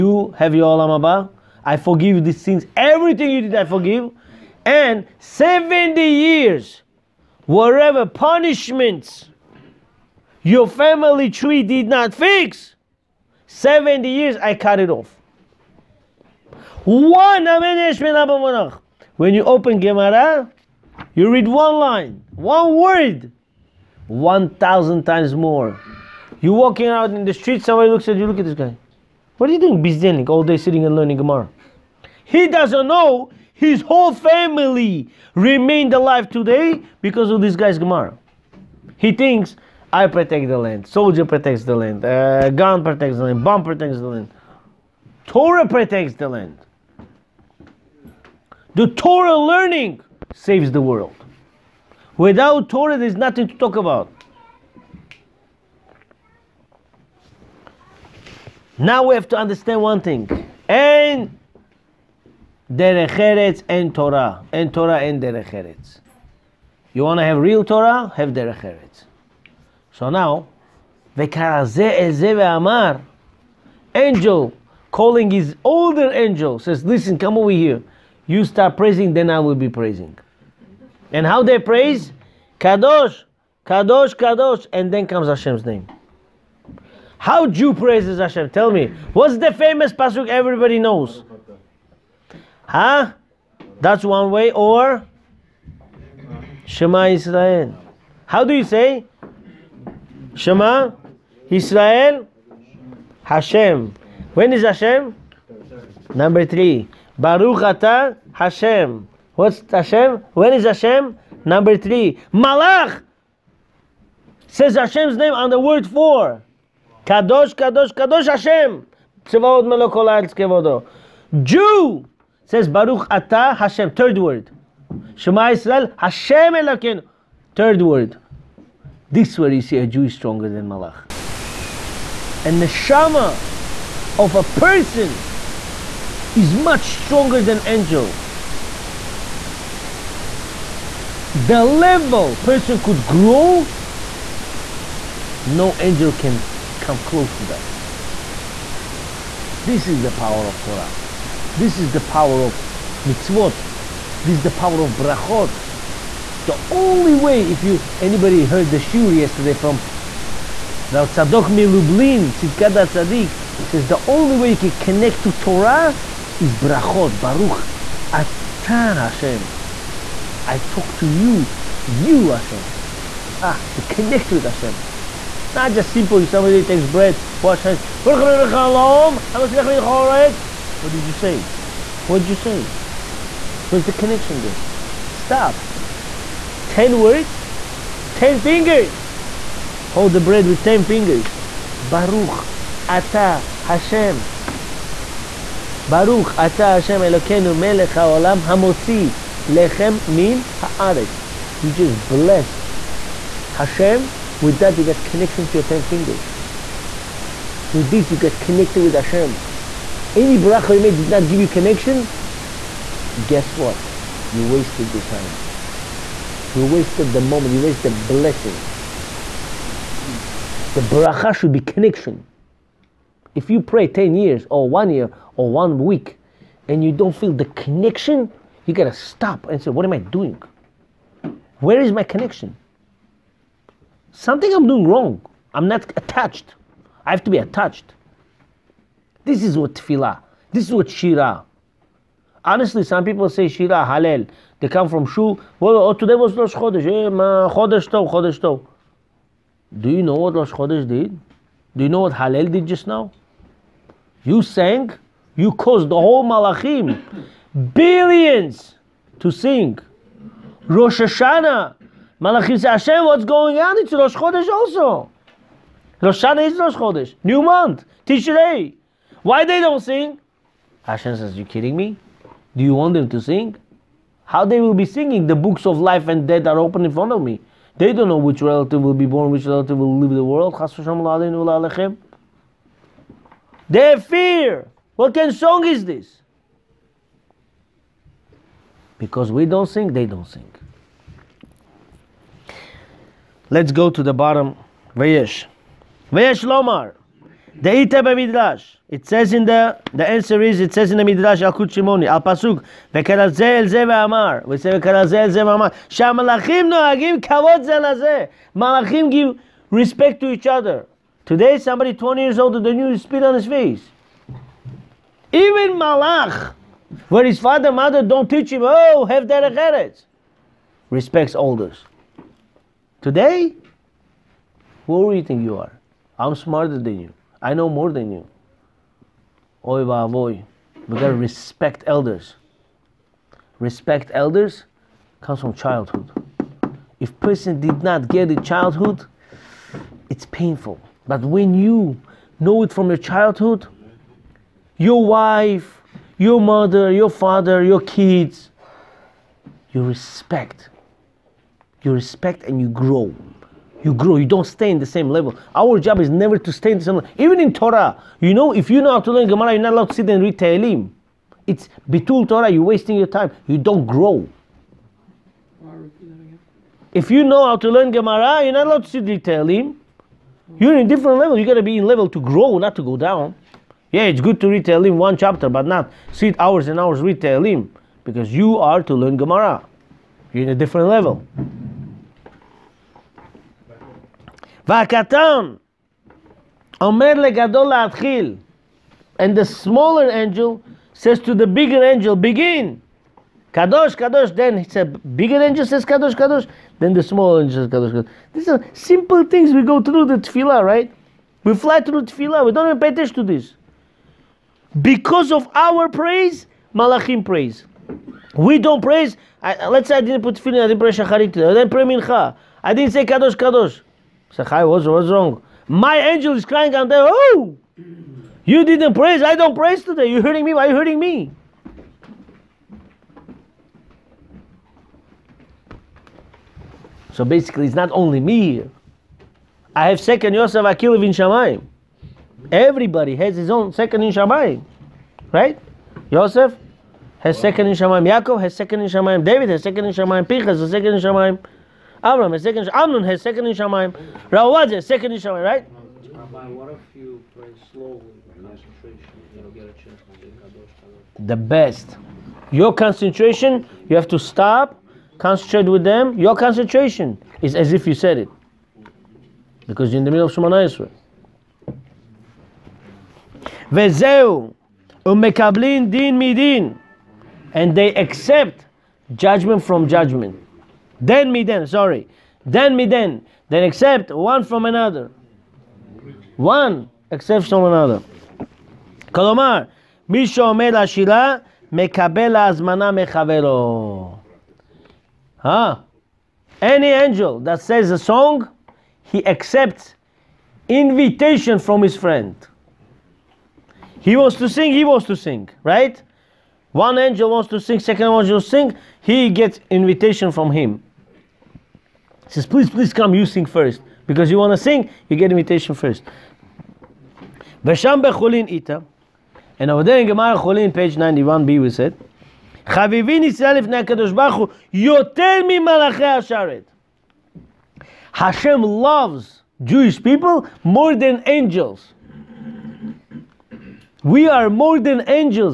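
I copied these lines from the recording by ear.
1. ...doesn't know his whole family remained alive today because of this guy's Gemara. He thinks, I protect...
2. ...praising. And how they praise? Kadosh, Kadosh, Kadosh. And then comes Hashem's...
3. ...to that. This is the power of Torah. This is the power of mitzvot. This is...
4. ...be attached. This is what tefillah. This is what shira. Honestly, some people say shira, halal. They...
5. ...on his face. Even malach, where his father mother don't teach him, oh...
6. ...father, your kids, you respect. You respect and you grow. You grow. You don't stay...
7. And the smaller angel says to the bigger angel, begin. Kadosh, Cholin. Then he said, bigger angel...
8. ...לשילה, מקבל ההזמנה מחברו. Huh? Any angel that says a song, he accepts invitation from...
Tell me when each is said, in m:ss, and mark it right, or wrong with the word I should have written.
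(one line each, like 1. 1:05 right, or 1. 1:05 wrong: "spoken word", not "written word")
1. 0:32 right
2. 1:19 right
3. 2:27 right
4. 3:57 right
5. 5:13 right
6. 5:47 right
7. 6:29 wrong: "Kadosh", not "Cholin"
8. 8:00 right.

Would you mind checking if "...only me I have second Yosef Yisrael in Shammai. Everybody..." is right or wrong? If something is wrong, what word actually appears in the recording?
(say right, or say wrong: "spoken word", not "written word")
wrong: "Akilov", not "Yisrael".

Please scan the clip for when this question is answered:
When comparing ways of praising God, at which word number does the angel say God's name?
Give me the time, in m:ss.
1:55.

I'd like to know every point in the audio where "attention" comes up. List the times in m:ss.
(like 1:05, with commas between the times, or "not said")
6:42.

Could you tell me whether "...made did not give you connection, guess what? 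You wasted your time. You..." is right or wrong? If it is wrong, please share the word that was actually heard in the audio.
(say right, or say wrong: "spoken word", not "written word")
right.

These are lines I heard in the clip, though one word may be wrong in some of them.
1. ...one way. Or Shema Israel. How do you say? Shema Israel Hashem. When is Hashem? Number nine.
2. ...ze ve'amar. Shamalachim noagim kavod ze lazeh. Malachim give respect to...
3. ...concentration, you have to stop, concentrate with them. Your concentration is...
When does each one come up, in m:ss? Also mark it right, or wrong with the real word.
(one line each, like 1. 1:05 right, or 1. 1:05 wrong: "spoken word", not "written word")
1. 1:34 wrong: "three", not "nine"
2. 5:05 right
3. 7:32 right.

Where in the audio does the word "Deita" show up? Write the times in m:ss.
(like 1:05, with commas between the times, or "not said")
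4:57.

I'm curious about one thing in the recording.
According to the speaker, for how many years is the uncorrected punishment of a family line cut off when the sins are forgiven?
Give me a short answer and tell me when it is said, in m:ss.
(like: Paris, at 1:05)
70, at 0:13.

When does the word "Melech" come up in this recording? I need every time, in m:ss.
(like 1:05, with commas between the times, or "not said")
3:17.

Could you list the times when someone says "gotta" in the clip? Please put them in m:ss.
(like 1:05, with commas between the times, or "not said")
3:48, 5:30.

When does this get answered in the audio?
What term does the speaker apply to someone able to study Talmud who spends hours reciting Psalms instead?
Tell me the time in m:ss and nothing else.
6:01.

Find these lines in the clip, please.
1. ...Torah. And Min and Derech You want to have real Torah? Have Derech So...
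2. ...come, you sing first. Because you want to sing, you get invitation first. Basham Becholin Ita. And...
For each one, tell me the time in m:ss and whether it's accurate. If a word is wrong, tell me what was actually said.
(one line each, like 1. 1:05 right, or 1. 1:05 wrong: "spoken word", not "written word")
1. 1:03 wrong: "Torah", not "Min"
2. 8:22 right.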